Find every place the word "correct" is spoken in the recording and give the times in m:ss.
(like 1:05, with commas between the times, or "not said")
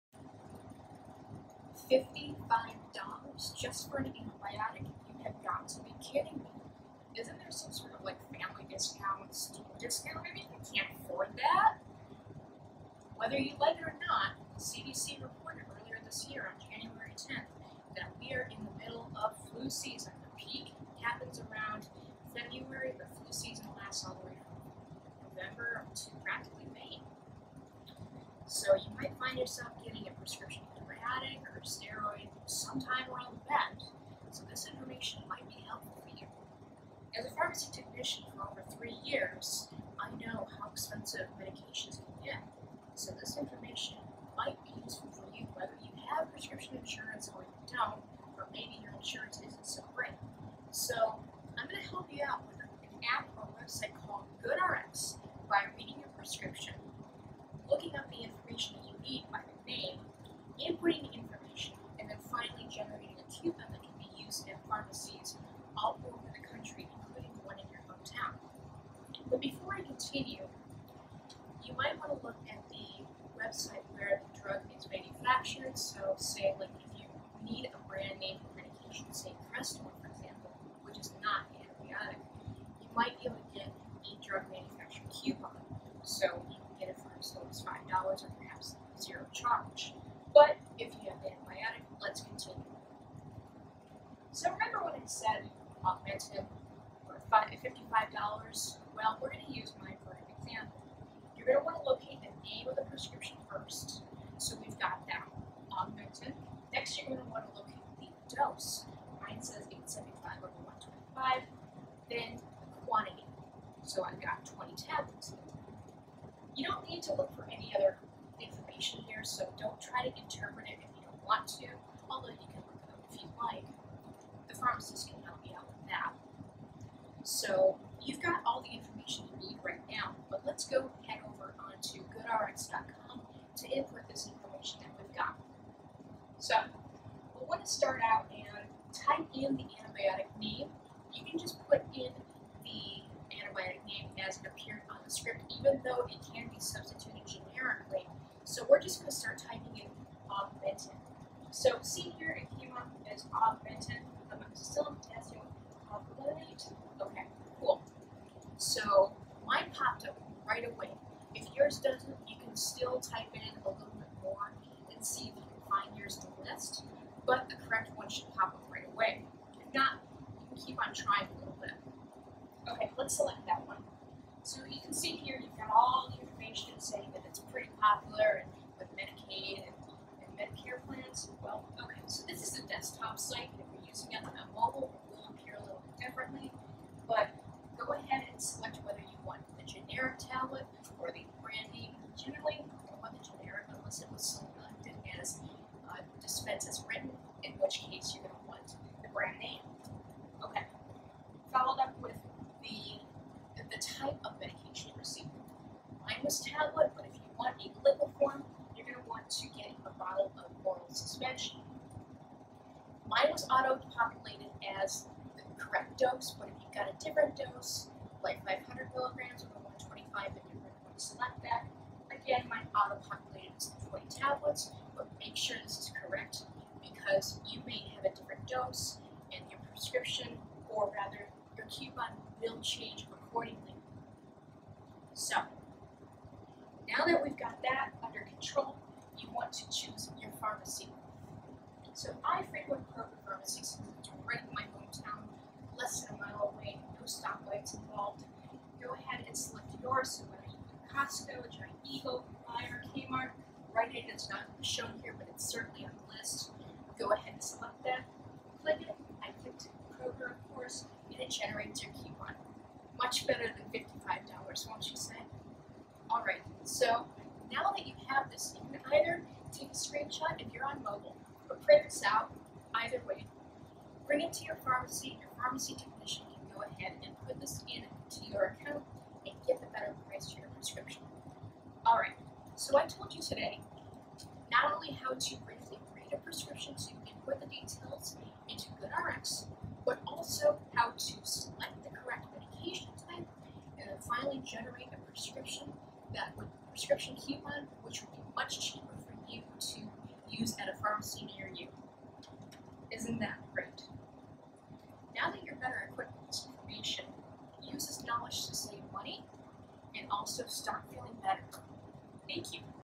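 2:47, 3:35, 4:51.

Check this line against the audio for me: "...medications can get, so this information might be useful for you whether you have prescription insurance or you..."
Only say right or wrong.
right.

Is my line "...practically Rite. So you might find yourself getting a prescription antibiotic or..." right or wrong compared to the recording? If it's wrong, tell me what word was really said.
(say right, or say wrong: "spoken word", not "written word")
wrong: "May", not "Rite".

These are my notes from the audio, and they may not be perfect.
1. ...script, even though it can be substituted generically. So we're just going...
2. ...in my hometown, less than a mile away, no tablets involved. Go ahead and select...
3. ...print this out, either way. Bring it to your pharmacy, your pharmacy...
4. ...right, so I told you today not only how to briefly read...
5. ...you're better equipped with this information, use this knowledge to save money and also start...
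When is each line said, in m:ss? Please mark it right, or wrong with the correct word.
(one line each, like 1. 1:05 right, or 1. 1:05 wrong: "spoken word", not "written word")
1. 2:25 right
2. 4:04 wrong: "stoplights", not "tablets"
3. 4:31 right
4. 4:41 right
5. 5:05 right.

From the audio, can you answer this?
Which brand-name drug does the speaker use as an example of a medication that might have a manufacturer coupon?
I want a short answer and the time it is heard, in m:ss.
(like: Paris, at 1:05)
Crestor, at 1:19.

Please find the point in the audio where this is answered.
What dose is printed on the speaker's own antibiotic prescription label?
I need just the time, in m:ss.
1:49.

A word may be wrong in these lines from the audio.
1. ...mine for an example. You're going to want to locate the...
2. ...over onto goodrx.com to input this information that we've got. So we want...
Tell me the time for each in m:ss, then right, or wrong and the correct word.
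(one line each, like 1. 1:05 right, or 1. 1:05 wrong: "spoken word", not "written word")
1. 1:39 right
2. 2:11 right.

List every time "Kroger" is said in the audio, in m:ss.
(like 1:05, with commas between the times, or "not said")
4:02, 4:20.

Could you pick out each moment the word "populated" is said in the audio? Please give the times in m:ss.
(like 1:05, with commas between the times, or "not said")
3:33, 3:42.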